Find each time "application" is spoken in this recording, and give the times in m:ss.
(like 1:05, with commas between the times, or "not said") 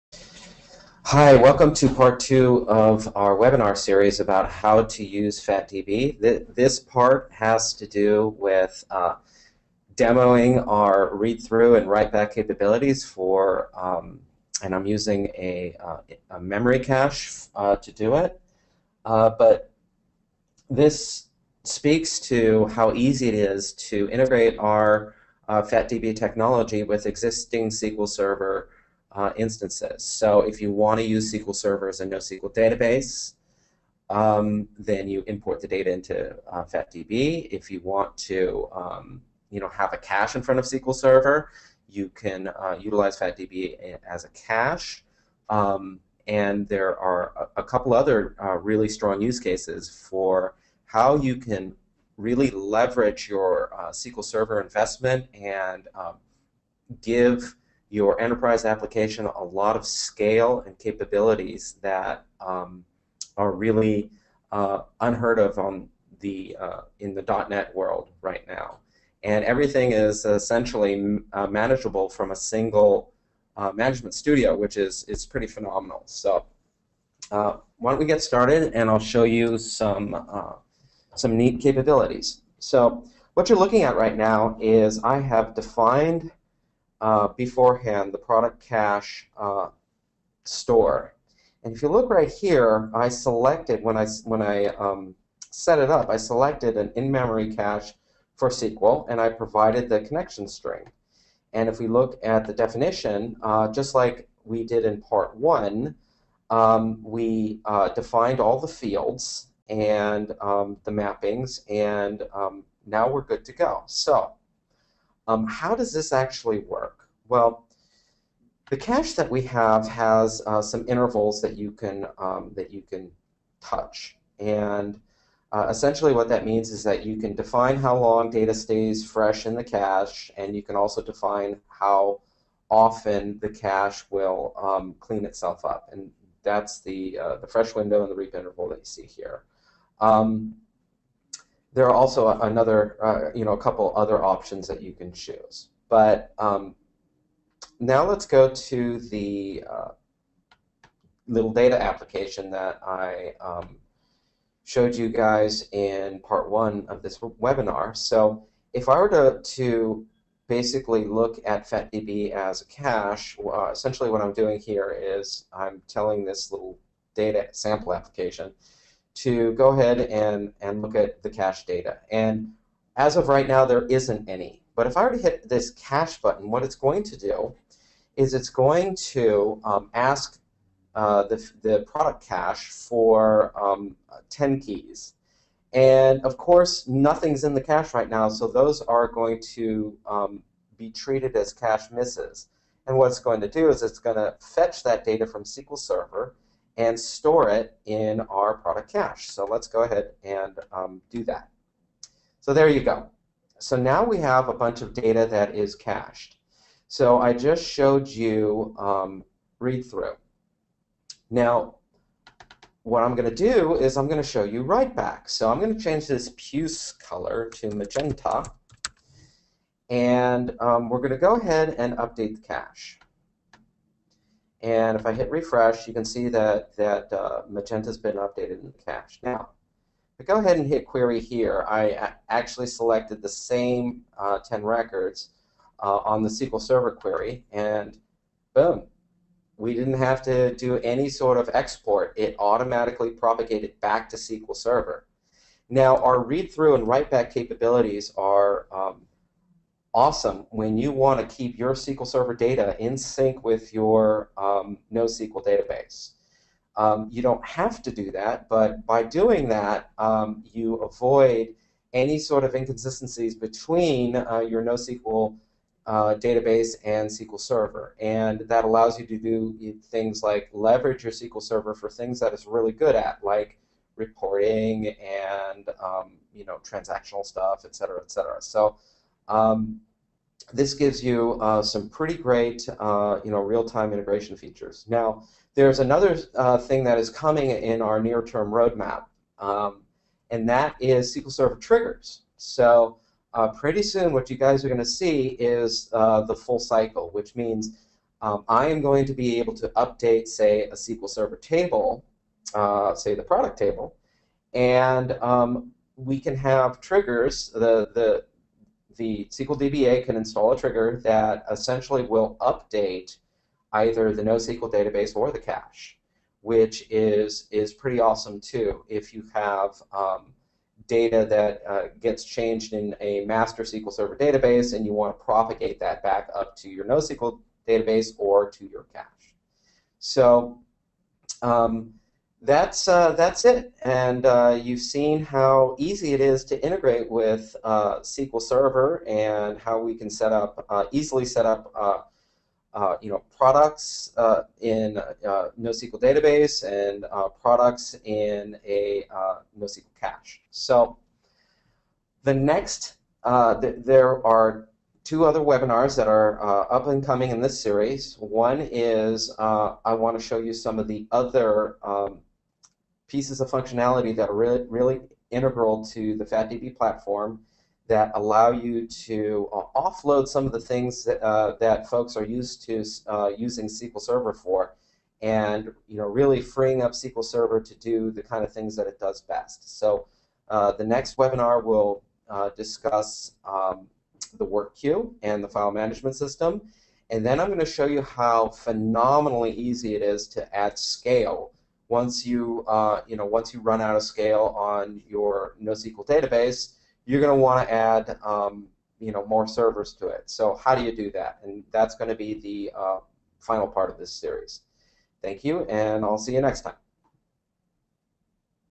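0:58, 2:31, 2:47.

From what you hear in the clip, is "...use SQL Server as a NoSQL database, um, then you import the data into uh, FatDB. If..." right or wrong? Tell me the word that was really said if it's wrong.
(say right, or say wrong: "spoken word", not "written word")
right.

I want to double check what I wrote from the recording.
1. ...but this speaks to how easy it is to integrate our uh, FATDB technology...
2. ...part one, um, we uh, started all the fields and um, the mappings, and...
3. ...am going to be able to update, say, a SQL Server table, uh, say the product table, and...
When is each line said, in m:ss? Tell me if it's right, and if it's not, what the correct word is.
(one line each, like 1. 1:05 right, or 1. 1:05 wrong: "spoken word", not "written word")
1. 0:19 right
2. 1:45 wrong: "defined", not "started"
3. 4:58 right.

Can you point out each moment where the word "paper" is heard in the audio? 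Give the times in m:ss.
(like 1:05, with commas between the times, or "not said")
not said.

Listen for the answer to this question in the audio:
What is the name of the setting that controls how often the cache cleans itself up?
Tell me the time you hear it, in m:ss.
2:18.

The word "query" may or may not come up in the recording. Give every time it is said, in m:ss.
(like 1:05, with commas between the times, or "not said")
3:50, 3:56.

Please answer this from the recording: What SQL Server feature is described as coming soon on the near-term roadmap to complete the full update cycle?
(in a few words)
SQL Server triggers.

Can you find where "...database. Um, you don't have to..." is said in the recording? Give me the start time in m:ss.
4:15.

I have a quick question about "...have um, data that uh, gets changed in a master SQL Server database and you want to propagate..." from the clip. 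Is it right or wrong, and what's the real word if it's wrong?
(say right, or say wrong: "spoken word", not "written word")
right.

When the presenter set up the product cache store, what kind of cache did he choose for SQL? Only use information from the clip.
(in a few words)
In-memory cache.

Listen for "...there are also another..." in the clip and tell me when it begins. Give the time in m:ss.
2:21.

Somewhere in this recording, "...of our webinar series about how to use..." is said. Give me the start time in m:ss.
0:02.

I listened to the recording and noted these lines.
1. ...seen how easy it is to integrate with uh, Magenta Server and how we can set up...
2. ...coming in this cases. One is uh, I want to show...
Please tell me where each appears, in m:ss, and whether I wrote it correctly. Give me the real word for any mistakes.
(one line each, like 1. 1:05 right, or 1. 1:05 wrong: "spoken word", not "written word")
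1. 5:34 wrong: "SQL", not "Magenta"
2. 5:57 wrong: "series", not "cases".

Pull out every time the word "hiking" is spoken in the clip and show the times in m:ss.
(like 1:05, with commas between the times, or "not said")
not said.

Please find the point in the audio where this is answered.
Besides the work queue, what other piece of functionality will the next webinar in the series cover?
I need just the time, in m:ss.
6:25.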